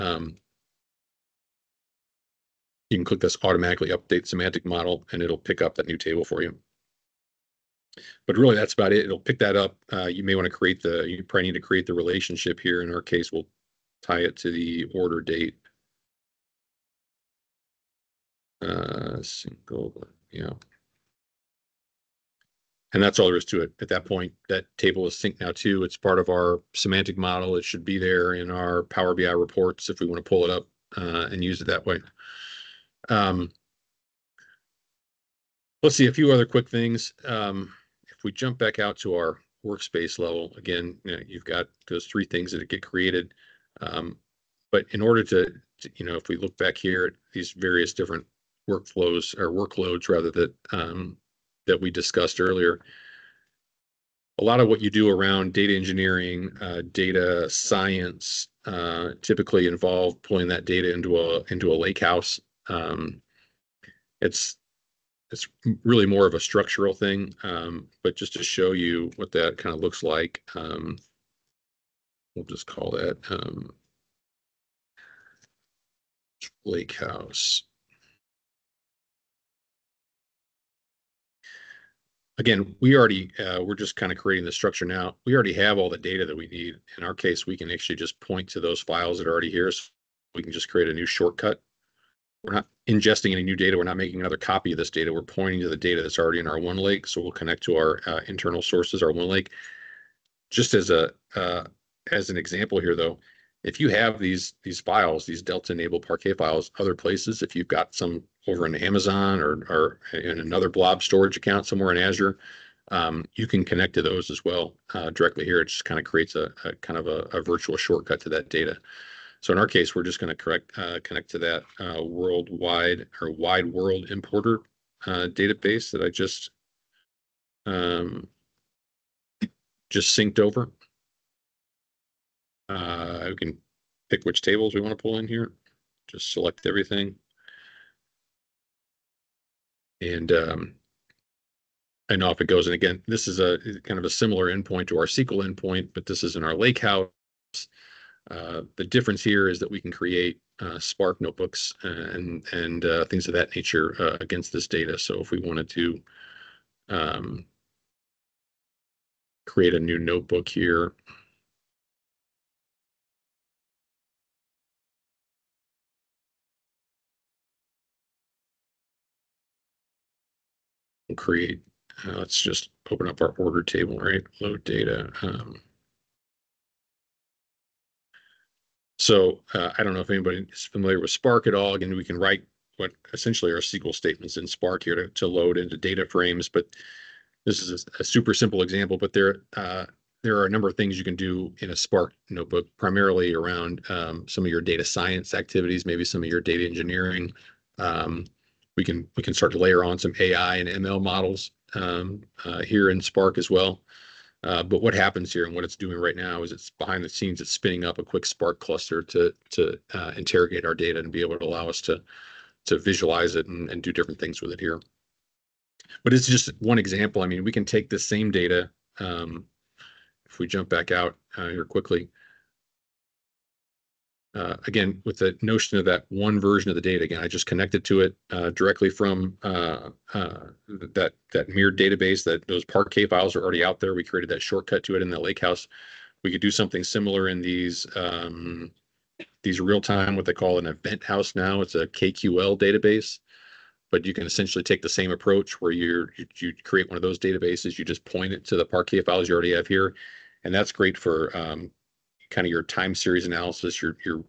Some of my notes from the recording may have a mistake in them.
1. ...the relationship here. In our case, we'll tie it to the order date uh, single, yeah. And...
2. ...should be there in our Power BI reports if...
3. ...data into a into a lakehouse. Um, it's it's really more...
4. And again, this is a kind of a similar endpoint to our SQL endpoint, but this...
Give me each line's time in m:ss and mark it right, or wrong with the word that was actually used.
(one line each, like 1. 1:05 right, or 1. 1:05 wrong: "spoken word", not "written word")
1. 0:11 right
2. 0:27 right
3. 1:00 right
4. 2:22 right.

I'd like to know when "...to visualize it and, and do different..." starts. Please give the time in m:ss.
3:32.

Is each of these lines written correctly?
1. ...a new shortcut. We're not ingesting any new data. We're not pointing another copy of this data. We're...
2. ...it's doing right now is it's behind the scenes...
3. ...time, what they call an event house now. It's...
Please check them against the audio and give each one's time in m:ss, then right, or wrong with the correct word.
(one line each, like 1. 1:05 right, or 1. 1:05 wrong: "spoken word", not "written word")
1. 1:30 wrong: "making", not "pointing"
2. 3:25 right
3. 3:59 right.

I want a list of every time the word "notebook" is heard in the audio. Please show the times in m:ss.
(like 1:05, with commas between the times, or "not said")
2:31, 2:39, 3:12.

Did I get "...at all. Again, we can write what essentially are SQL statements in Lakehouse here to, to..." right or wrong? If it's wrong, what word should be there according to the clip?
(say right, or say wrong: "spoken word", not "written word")
wrong: "Spark", not "Lakehouse".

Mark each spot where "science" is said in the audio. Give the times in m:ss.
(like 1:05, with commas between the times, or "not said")
0:57, 3:14.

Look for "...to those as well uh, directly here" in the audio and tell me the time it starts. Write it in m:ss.
1:53.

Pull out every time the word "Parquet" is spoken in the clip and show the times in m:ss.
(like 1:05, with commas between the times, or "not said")
1:46, 3:52, 4:08.